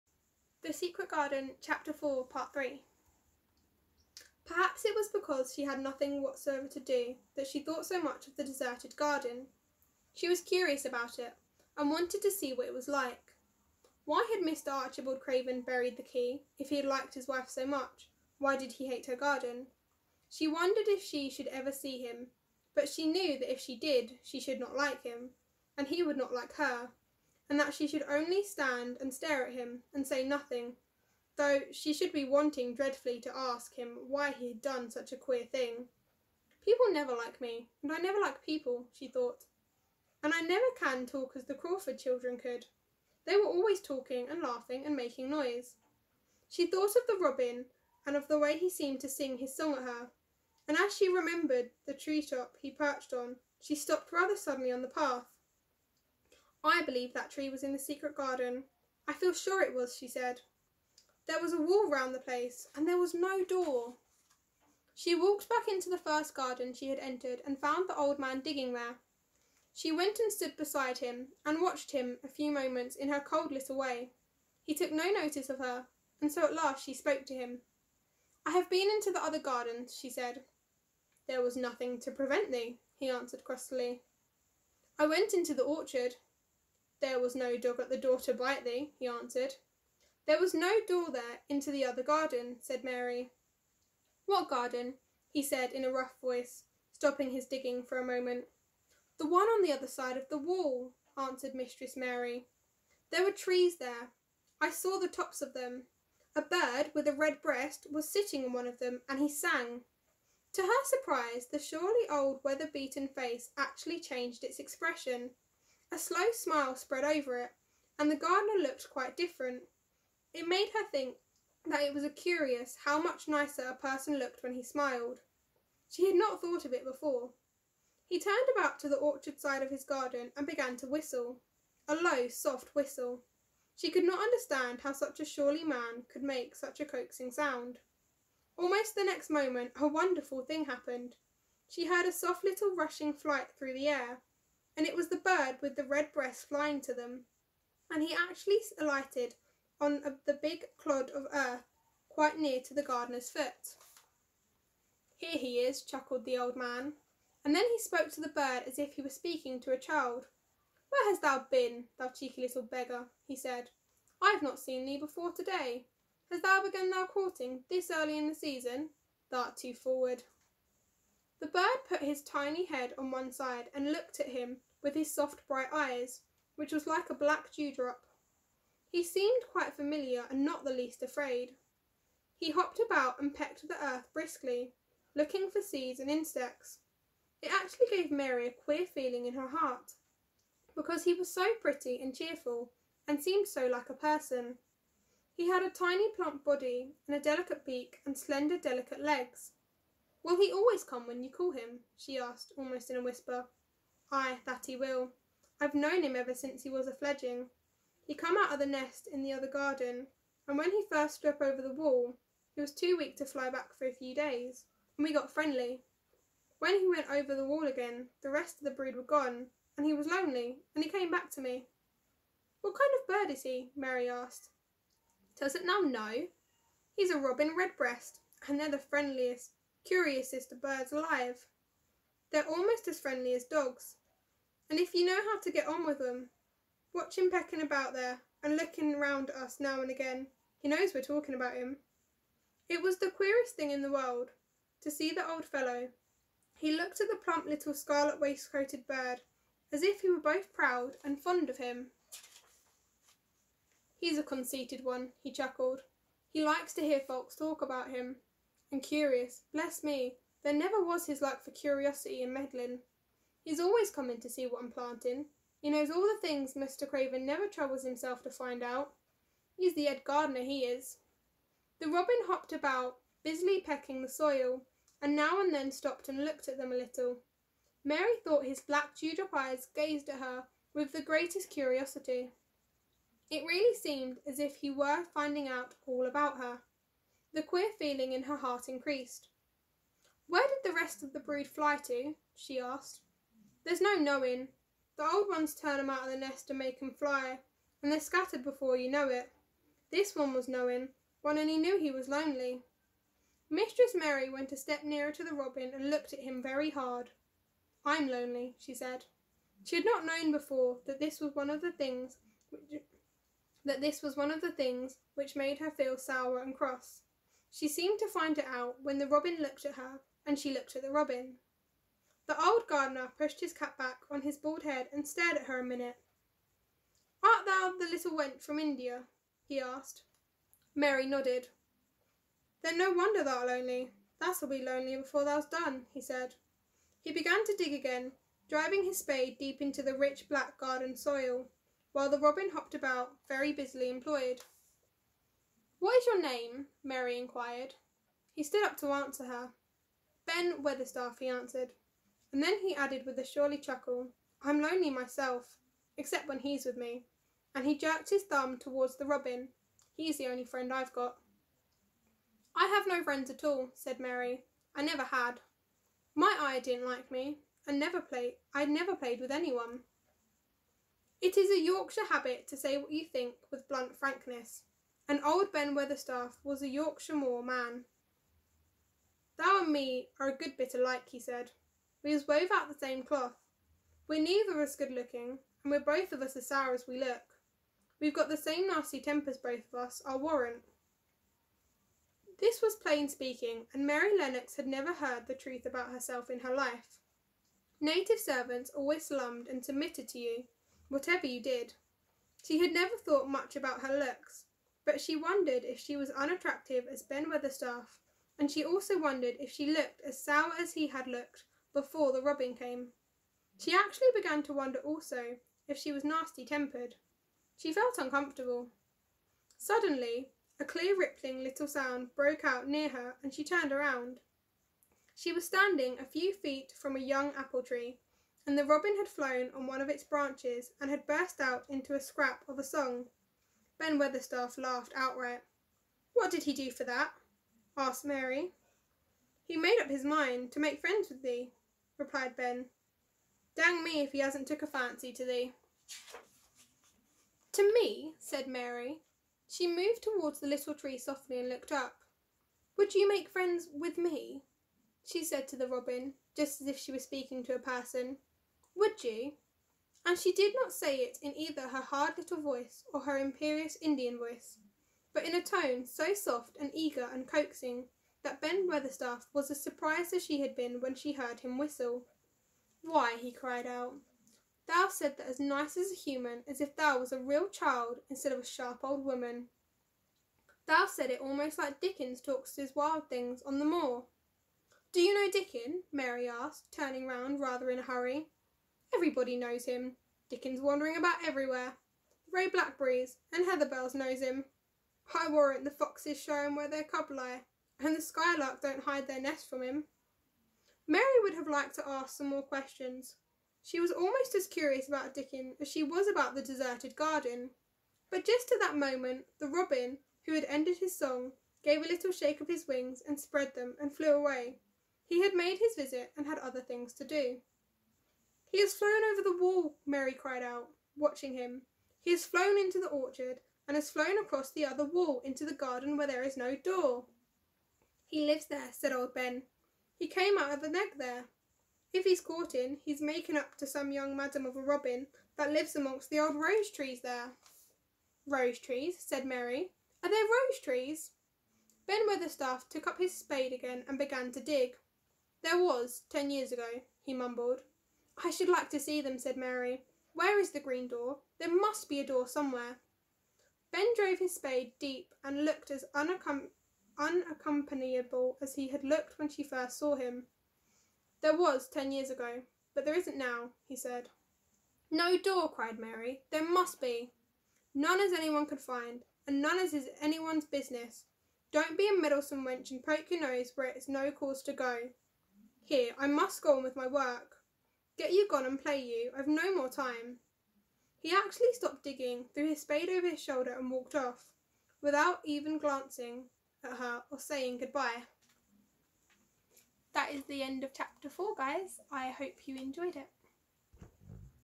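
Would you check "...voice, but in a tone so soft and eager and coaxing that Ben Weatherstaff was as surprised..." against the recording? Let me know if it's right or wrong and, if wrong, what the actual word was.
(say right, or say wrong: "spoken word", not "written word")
right.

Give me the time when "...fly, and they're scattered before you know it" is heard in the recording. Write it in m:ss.
4:56.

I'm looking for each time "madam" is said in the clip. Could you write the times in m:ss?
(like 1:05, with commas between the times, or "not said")
8:54.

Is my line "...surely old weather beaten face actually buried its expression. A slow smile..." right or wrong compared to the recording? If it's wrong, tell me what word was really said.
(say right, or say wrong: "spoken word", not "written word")
wrong: "changed", not "buried".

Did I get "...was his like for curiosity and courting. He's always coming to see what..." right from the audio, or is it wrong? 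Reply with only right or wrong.
wrong.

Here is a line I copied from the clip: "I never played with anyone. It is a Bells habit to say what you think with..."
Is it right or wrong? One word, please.
wrong.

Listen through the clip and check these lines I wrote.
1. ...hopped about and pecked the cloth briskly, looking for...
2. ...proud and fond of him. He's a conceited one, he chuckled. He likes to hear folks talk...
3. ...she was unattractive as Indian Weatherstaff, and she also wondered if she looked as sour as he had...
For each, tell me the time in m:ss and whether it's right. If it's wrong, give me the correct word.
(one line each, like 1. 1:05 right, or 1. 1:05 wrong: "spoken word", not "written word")
1. 3:02 wrong: "earth", not "cloth"
2. 4:10 right
3. 6:45 wrong: "Ben", not "Indian".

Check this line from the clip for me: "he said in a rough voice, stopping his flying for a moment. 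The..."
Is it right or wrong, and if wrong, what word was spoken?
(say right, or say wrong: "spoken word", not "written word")
wrong: "digging", not "flying".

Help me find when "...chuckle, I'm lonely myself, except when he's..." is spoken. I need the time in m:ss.
5:53.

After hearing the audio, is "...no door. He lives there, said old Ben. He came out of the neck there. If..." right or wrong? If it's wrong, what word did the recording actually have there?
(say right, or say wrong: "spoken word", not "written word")
right.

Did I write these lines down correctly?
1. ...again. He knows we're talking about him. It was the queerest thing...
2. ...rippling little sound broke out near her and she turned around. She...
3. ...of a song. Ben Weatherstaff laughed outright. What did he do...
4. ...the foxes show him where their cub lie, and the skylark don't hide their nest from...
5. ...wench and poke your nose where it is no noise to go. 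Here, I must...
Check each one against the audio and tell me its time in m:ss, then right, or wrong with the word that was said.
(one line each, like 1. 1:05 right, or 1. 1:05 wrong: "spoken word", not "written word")
1. 3:59 right
2. 7:00 right
3. 7:12 right
4. 8:15 right
5. 9:32 wrong: "cause", not "noise".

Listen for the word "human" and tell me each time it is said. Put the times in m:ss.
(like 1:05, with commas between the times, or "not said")
7:55.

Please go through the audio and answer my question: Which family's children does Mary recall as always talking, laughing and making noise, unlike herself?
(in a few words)
The Crawford children.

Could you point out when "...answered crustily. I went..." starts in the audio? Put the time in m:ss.
1:23.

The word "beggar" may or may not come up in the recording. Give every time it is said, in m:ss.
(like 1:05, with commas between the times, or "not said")
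2:42.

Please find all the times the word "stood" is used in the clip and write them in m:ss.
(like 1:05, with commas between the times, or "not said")
1:10, 5:48.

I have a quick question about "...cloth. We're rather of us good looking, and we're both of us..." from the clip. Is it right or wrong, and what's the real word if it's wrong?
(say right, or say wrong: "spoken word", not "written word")
wrong: "neither", not "rather".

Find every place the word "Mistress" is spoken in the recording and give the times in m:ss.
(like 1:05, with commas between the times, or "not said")
1:41, 5:03.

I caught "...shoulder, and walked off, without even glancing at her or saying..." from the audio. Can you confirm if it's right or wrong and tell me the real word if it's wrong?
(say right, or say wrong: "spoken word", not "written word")
right.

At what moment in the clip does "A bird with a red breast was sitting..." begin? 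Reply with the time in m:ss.
1:46.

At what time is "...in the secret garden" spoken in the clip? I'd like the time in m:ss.
0:57.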